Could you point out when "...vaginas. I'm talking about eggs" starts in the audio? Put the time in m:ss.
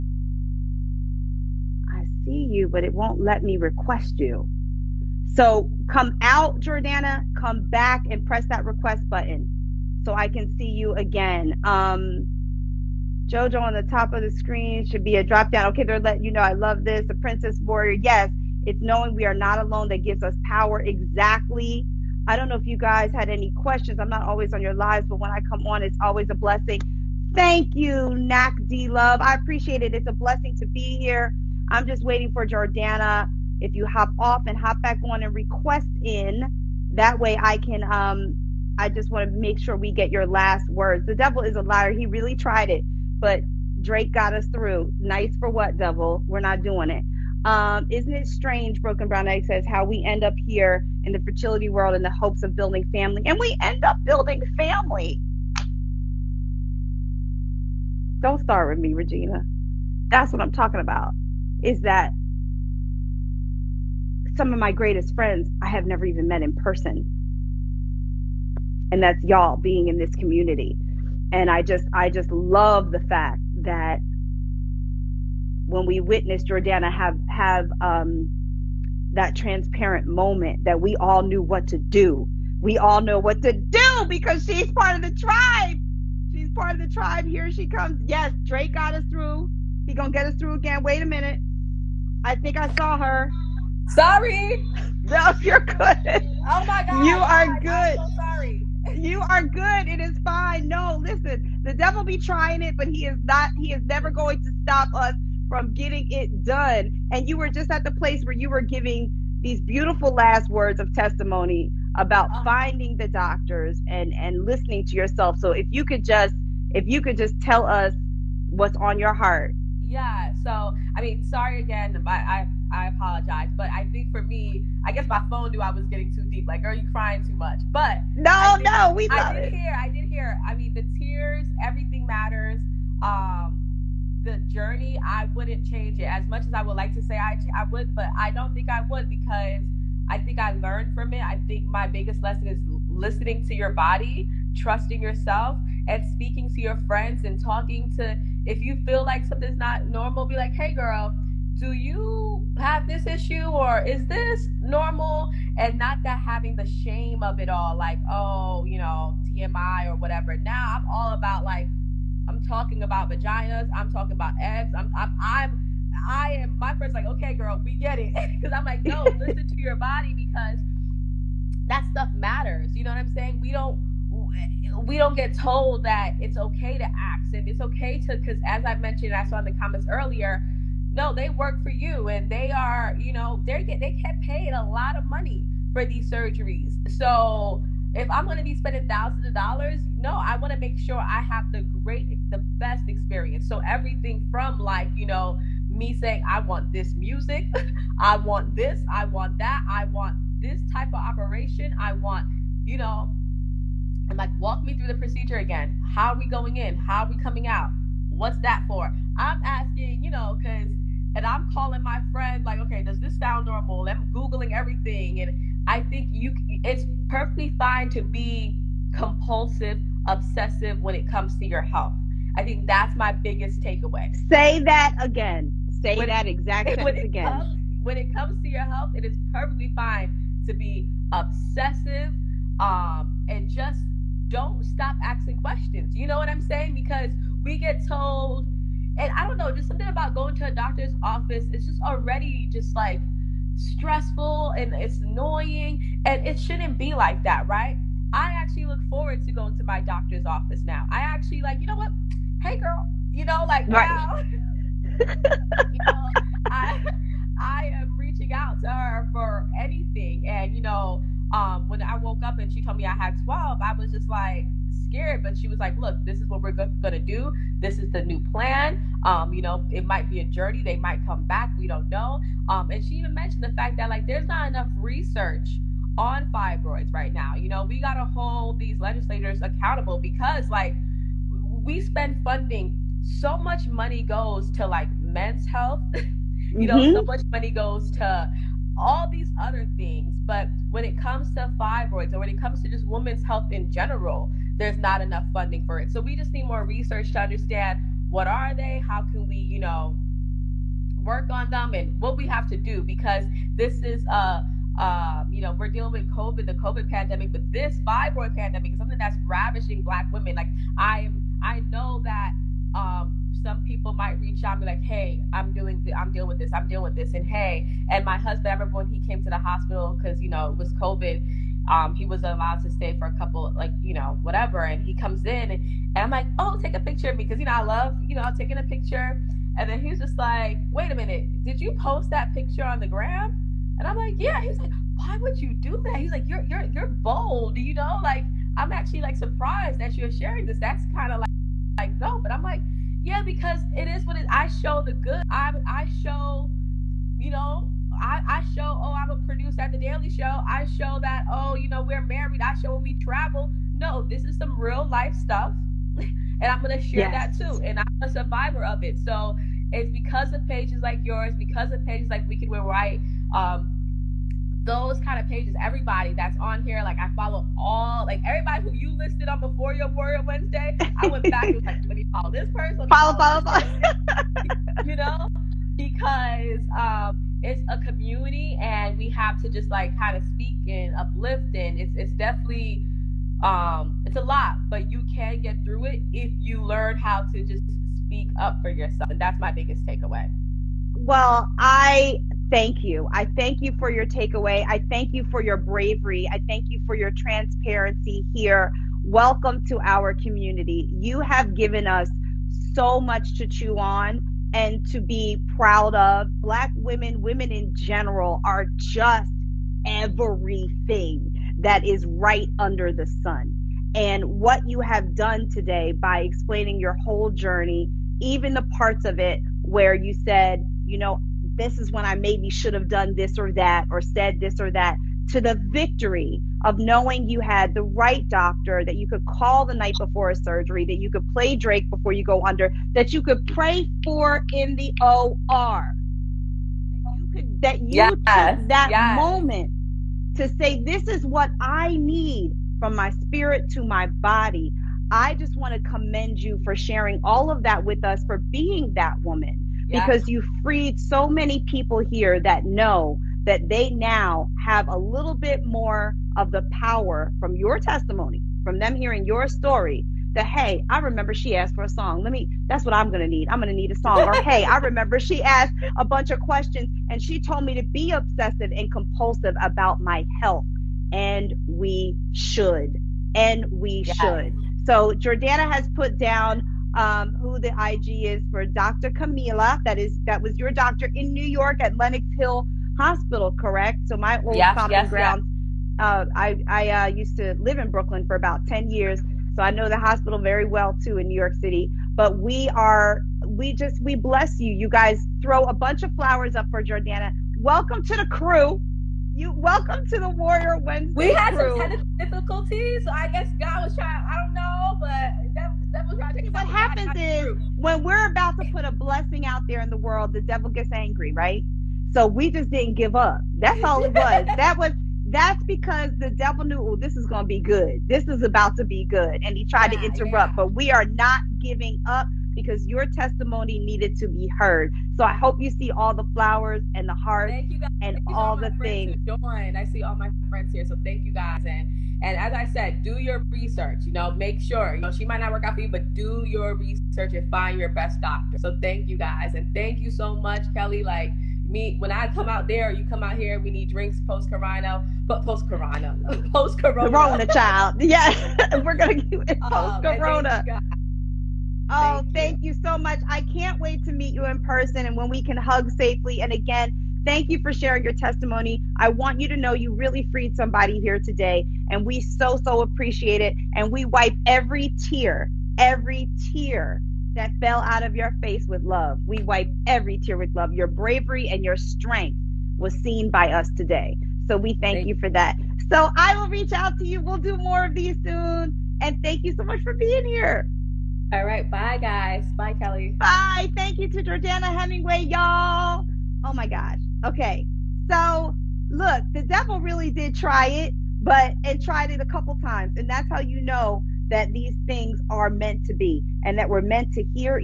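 2:43.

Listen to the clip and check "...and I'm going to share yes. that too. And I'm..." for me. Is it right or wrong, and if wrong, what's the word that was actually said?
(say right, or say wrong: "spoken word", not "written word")
right.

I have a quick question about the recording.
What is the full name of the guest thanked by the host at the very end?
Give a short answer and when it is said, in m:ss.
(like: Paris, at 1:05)
Jordana Hemingway, at 9:44.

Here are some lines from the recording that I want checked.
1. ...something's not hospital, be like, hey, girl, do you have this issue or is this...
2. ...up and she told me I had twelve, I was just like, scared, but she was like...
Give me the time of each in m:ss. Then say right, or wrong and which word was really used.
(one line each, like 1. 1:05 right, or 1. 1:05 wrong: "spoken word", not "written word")
1. 2:29 wrong: "normal", not "hospital"
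2. 4:22 right.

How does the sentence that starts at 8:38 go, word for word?
This is about to be good.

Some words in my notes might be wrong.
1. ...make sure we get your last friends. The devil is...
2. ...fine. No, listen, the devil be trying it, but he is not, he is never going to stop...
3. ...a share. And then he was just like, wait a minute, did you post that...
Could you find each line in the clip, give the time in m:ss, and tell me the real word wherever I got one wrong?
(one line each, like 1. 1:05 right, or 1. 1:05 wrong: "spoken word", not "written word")
1. 0:39 wrong: "words", not "friends"
2. 1:40 right
3. 5:28 wrong: "picture", not "share".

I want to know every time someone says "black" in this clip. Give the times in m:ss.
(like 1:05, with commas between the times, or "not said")
5:09, 6:46.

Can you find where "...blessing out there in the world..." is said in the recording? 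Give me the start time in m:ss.
8:28.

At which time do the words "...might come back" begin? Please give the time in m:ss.
4:30.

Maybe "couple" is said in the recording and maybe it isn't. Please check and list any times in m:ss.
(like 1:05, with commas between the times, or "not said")
5:23, 9:52.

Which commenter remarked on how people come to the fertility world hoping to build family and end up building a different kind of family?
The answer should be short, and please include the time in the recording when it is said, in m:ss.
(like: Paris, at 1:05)
Broken Brown Egg, at 0:48.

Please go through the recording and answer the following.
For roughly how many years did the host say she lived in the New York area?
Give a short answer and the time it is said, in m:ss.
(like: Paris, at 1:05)
10, at 8:08.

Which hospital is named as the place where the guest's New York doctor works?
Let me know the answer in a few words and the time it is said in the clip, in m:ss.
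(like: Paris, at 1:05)
Lenox Hill, at 8:01.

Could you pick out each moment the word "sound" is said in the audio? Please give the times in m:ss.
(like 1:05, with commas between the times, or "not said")
3:33.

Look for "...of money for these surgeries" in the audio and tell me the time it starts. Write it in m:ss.
3:04.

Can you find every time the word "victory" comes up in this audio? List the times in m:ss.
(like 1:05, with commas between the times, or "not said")
7:05.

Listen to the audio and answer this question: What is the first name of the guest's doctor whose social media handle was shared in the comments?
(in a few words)
Camila.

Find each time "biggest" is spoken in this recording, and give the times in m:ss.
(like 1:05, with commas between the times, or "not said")
2:21, 3:43, 6:29.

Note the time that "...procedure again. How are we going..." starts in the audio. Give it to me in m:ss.
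3:24.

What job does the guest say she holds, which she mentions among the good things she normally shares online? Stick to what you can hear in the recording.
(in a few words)
Producer at the Daily Show.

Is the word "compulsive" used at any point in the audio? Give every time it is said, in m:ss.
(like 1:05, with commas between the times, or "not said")
3:38, 7:48.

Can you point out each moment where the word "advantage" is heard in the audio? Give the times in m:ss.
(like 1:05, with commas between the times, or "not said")
not said.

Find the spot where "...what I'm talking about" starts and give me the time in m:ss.
1:00.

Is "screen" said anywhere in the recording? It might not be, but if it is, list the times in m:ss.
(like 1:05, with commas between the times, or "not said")
0:14.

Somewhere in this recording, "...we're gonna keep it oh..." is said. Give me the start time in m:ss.
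9:08.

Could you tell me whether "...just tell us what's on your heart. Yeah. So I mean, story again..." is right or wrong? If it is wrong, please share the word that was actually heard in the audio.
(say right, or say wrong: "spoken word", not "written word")
wrong: "sorry", not "story".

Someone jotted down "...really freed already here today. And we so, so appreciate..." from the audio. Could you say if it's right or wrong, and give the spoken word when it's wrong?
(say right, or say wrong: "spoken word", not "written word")
wrong: "somebody", not "already".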